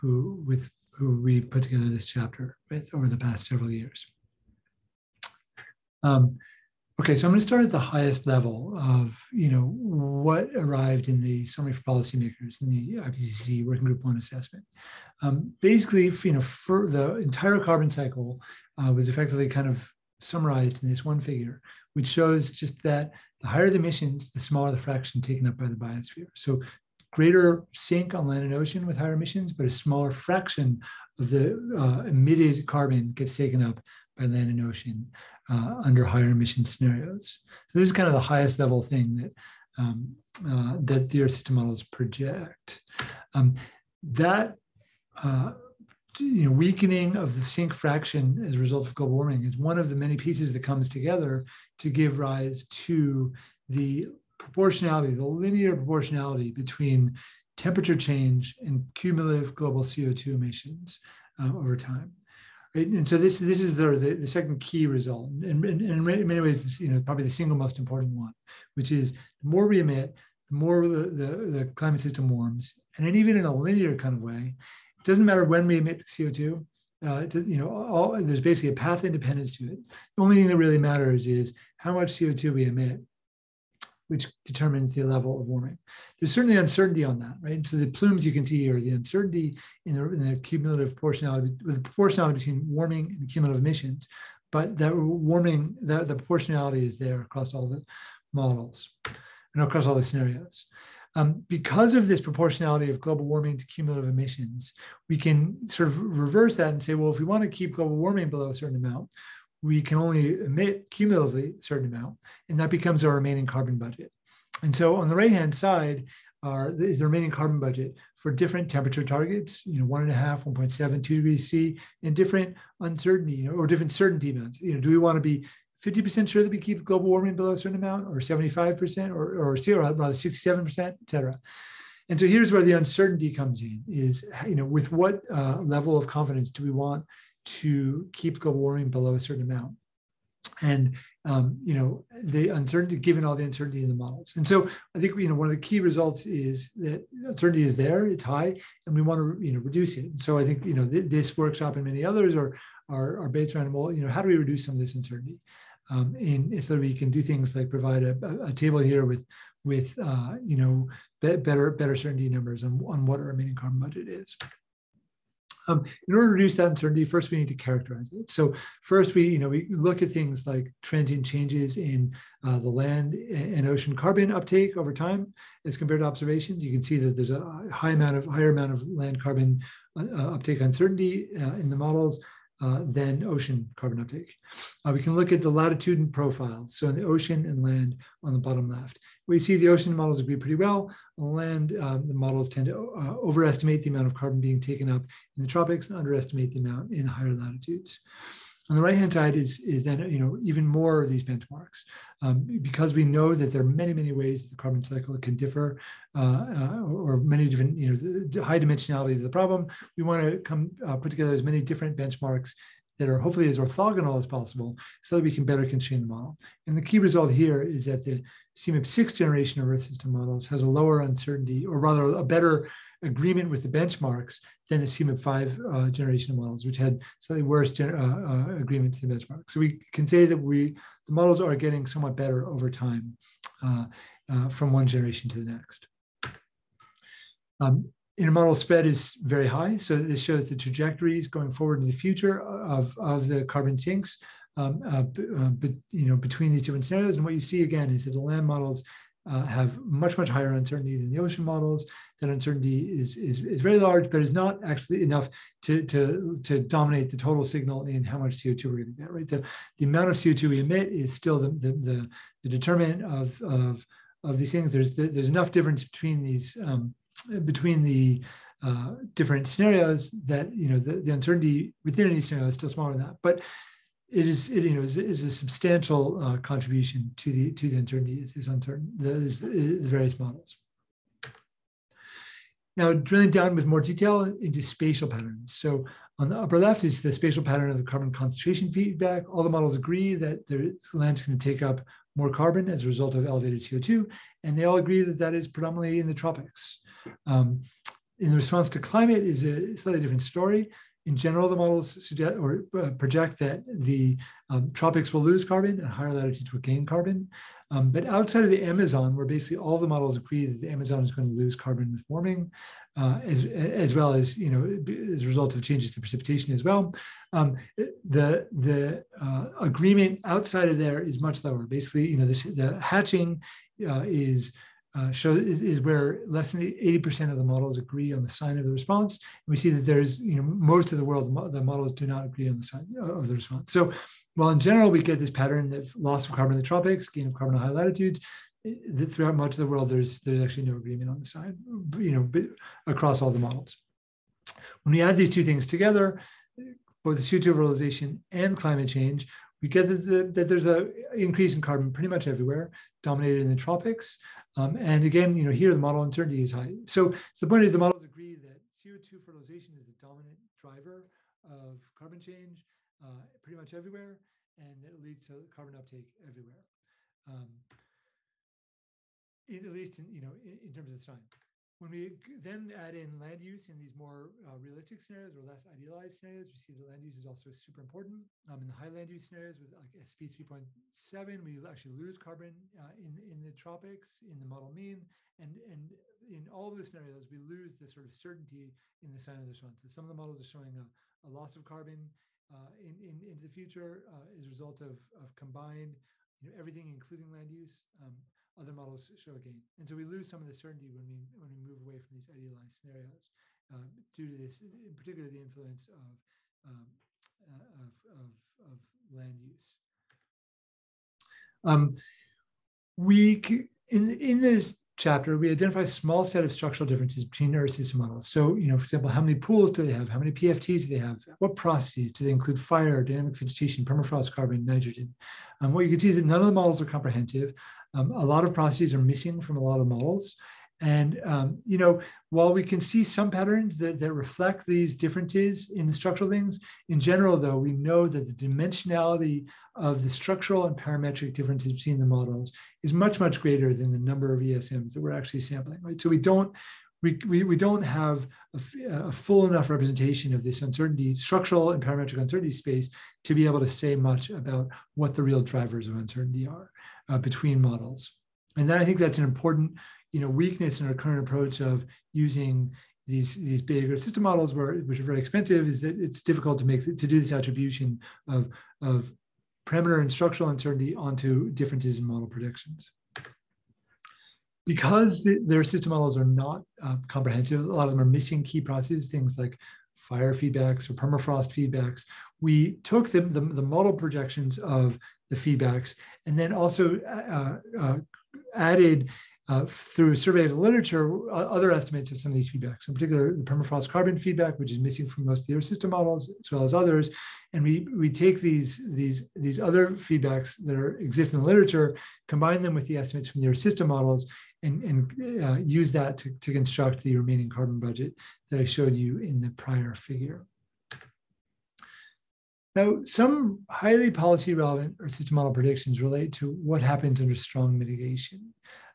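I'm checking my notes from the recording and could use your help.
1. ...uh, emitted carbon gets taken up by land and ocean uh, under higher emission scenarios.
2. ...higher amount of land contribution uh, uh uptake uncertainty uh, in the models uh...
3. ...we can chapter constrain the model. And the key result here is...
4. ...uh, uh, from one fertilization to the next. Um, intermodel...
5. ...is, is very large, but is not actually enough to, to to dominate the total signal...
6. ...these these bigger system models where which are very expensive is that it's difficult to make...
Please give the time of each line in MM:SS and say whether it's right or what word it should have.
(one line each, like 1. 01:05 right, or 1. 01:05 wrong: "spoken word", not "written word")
1. 00:31 right
2. 02:58 wrong: "carbon", not "contribution"
3. 03:35 wrong: "better", not "chapter"
4. 03:53 wrong: "generation", not "fertilization"
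5. 04:13 right
6. 07:43 right.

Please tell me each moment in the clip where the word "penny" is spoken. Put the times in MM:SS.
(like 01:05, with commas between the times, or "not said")
not said.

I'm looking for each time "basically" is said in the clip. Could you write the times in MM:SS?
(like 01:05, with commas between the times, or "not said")
00:15, 01:18, 05:09, 05:21.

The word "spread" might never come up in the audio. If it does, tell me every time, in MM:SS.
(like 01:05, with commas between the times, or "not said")
03:58.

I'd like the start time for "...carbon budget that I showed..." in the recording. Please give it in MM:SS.
08:27.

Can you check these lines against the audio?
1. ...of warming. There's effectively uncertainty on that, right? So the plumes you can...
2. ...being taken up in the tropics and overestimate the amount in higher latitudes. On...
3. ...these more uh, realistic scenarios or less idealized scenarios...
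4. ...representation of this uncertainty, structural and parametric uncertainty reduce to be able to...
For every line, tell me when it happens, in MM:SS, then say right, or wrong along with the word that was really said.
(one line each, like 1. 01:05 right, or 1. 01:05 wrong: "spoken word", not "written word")
1. 01:25 wrong: "certainly", not "effectively"
2. 03:14 wrong: "underestimate", not "overestimate"
3. 06:13 right
4. 07:29 wrong: "space", not "reduce".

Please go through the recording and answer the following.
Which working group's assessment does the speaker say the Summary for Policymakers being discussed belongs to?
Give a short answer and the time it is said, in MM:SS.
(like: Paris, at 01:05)
Working Group One, at 00:13.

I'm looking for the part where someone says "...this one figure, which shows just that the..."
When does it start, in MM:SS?
00:20.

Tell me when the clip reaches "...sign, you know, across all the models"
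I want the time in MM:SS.
05:41.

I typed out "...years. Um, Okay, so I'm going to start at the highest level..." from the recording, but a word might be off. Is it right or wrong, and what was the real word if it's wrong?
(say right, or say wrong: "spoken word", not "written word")
right.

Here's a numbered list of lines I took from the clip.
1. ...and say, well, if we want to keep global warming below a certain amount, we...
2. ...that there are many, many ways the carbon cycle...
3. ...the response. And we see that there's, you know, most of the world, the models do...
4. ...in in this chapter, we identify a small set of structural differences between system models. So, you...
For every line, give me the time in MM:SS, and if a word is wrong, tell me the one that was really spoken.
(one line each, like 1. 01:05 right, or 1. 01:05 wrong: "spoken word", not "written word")
1. 01:46 right
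2. 03:23 right
3. 05:28 right
4. 06:53 right.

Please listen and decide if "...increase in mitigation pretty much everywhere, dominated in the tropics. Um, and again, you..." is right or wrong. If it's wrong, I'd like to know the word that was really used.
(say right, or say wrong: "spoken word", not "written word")
wrong: "carbon", not "mitigation".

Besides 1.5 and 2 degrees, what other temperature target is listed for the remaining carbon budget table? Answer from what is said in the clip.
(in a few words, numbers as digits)
1.7.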